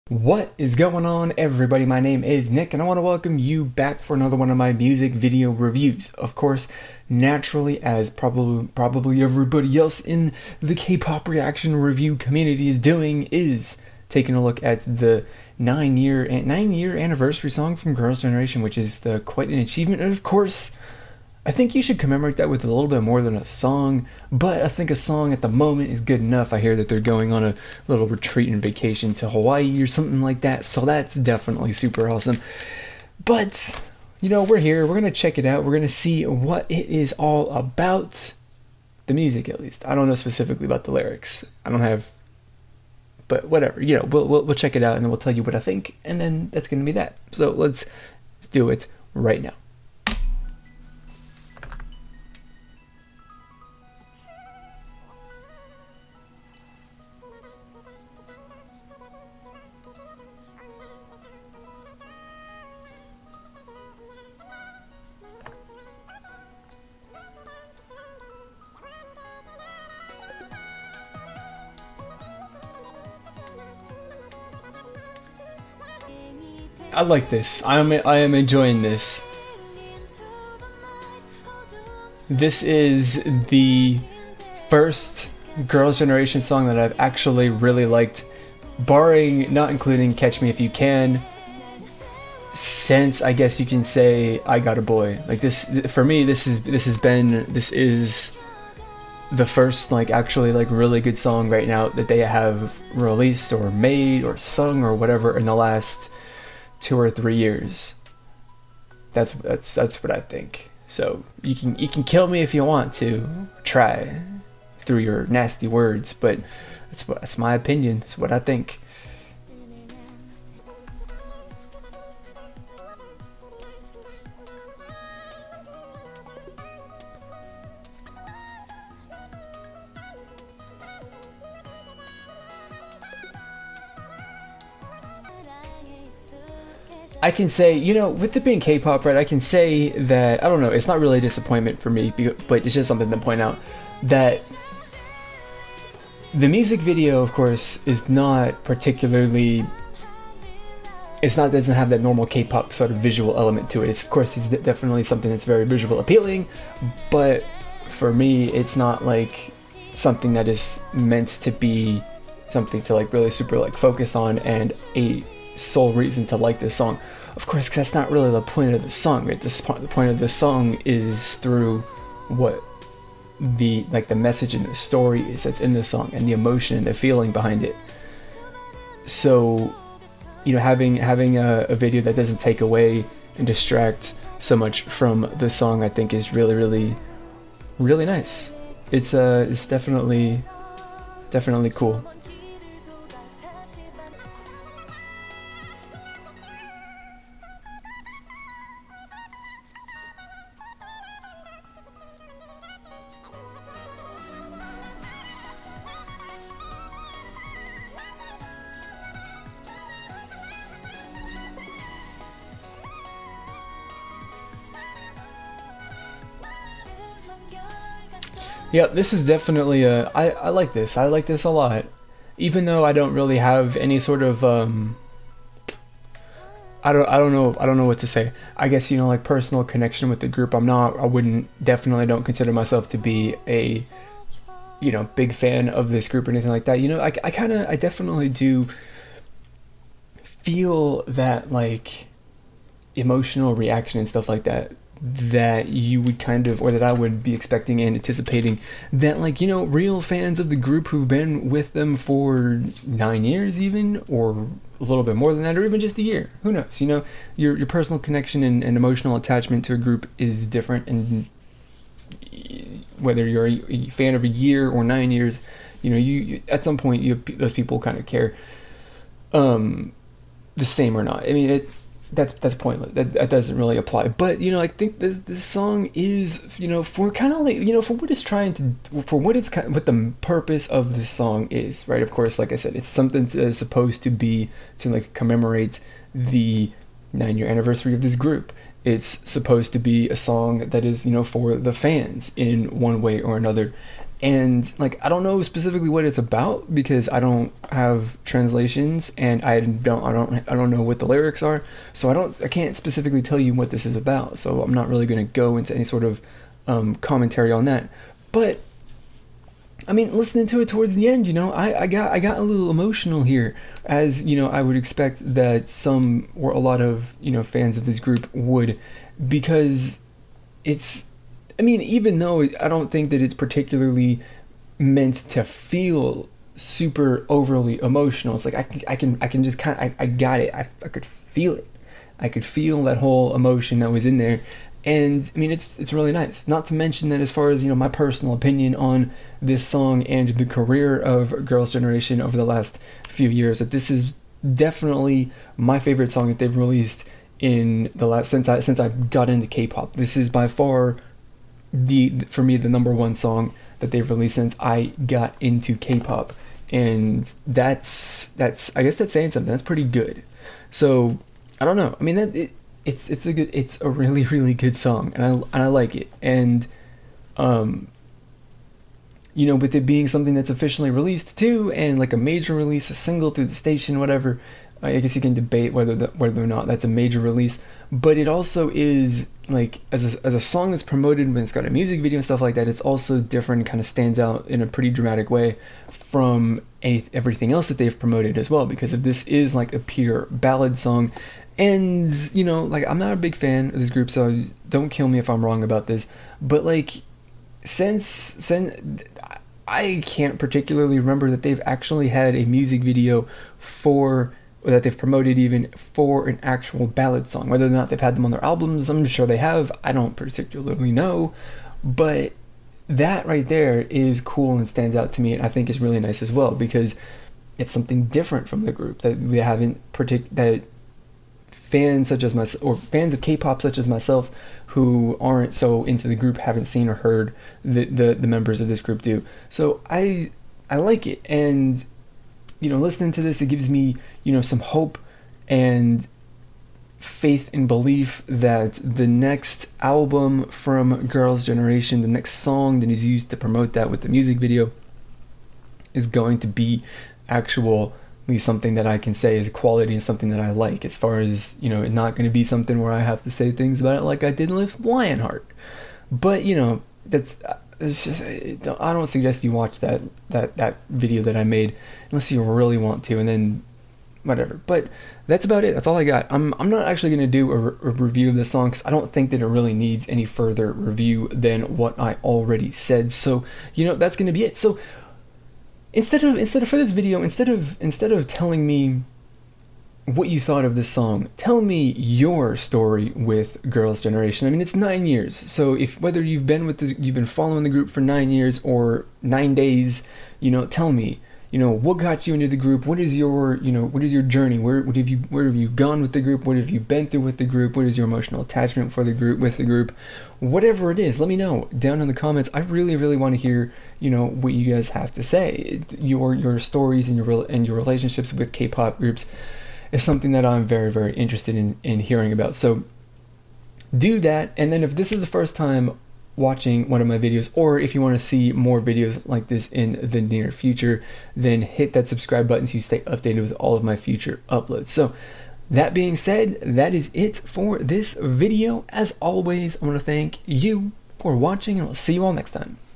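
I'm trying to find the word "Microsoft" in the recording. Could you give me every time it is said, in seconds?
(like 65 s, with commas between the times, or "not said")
not said.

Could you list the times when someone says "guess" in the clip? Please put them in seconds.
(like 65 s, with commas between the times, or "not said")
93 s, 228 s, 358 s, 374 s.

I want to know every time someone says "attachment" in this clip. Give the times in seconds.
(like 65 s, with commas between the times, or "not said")
259 s, 498 s.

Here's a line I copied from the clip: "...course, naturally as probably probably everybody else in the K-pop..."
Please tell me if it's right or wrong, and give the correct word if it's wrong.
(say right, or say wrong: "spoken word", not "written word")
right.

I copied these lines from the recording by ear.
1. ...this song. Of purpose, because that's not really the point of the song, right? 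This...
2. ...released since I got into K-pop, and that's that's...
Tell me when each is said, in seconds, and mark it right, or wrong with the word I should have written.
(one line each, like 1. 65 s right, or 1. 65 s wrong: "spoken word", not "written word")
1. 166 s wrong: "course", not "purpose"
2. 354 s right.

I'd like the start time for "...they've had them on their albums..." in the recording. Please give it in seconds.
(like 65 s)
407 s.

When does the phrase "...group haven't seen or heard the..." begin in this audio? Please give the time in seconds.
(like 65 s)
426 s.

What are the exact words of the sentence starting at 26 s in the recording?
I hear that they're going on a little retreat and vacation to Hawaii or something like that, so that's definitely super awesome.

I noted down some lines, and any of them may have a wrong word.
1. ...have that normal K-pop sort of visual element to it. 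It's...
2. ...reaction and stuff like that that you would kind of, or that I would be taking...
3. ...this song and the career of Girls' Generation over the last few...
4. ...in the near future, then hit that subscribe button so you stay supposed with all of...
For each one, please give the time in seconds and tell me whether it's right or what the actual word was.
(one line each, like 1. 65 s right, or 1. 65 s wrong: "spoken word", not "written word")
1. 151 s right
2. 243 s wrong: "expecting", not "taking"
3. 339 s right
4. 519 s wrong: "updated", not "supposed".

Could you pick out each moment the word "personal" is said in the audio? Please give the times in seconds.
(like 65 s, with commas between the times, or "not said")
229 s, 257 s, 337 s.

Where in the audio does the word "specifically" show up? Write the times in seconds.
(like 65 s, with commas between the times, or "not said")
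40 s, 295 s, 302 s.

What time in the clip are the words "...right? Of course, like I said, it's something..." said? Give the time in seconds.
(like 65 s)
281 s.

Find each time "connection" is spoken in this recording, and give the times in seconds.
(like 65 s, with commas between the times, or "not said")
229 s, 257 s.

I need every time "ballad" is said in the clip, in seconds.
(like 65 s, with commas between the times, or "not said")
390 s, 406 s.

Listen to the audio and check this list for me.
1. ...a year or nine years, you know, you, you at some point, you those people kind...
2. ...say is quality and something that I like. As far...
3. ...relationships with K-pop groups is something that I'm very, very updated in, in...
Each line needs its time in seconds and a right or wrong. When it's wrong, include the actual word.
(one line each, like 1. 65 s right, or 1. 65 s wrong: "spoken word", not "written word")
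1. 264 s right
2. 449 s right
3. 507 s wrong: "interested", not "updated".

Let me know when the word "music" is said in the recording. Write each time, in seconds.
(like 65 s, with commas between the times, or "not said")
4 s, 39 s, 146 s, 381 s, 402 s, 444 s.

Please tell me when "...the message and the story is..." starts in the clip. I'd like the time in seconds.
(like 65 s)
174 s.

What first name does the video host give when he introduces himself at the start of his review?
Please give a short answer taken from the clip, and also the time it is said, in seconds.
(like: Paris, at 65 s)
Nick, at 2 s.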